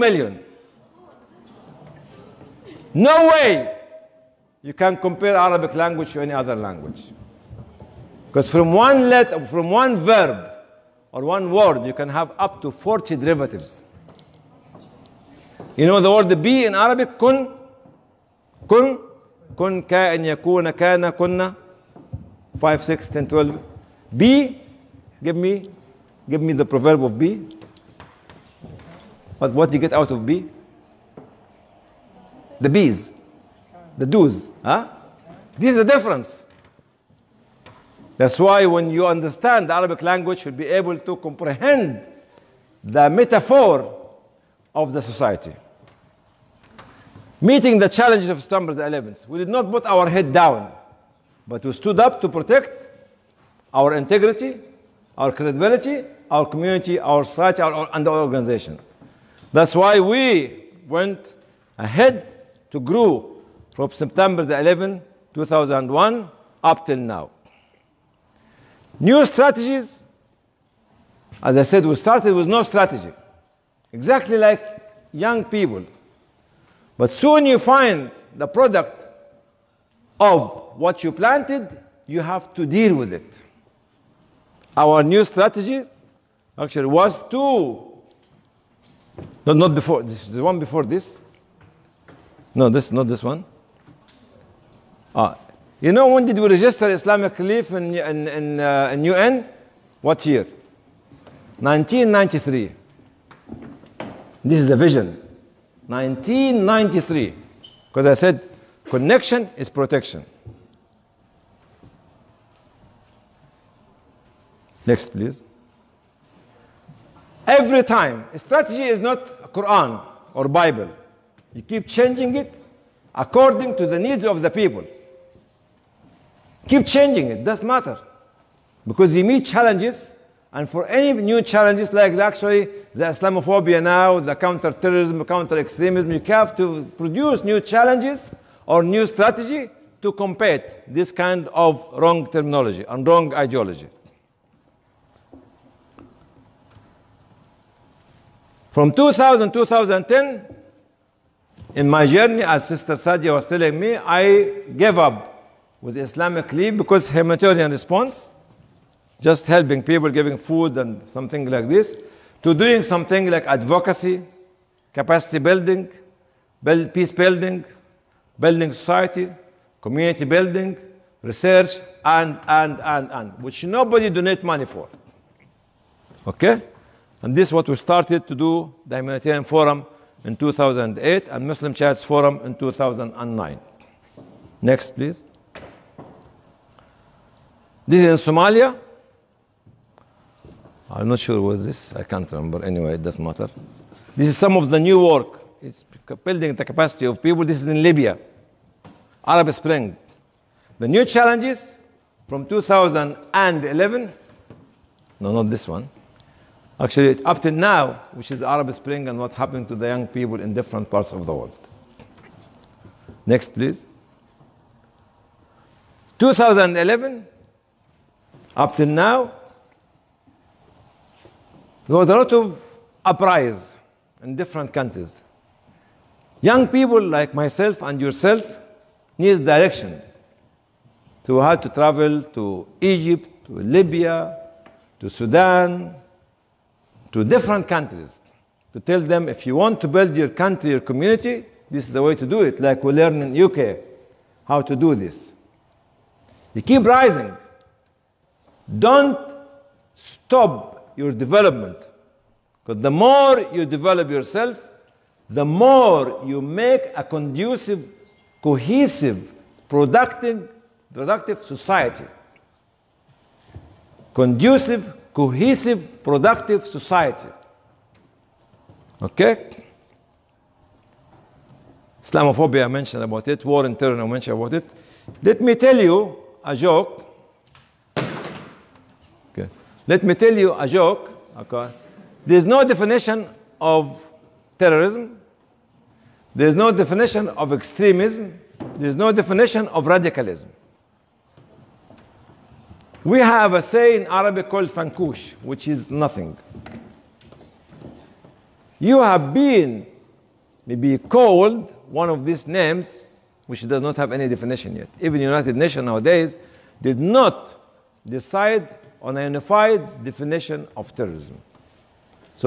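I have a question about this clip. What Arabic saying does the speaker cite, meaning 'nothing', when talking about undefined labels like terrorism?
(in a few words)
fankush.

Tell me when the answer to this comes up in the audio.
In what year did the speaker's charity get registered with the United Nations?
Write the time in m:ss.
1:41.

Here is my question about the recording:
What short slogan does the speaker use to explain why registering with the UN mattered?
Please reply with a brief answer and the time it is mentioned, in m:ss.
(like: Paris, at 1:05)
Connection is protection, at 1:48.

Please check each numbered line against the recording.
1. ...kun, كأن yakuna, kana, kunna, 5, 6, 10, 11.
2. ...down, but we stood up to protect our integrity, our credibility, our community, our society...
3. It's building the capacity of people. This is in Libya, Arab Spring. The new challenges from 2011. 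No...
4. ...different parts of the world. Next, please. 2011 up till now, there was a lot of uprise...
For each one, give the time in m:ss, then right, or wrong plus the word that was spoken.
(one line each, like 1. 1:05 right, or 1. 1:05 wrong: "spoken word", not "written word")
1. 0:19 wrong: "12", not "11"
2. 0:50 right
3. 3:15 right
4. 3:30 right.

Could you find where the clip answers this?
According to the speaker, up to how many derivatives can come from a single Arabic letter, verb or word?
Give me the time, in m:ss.
0:12.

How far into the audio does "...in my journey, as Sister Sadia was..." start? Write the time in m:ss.
2:31.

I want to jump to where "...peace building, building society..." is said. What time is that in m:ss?
2:46.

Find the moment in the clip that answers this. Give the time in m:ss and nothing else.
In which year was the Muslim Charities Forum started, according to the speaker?
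3:02.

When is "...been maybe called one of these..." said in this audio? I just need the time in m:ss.
4:59.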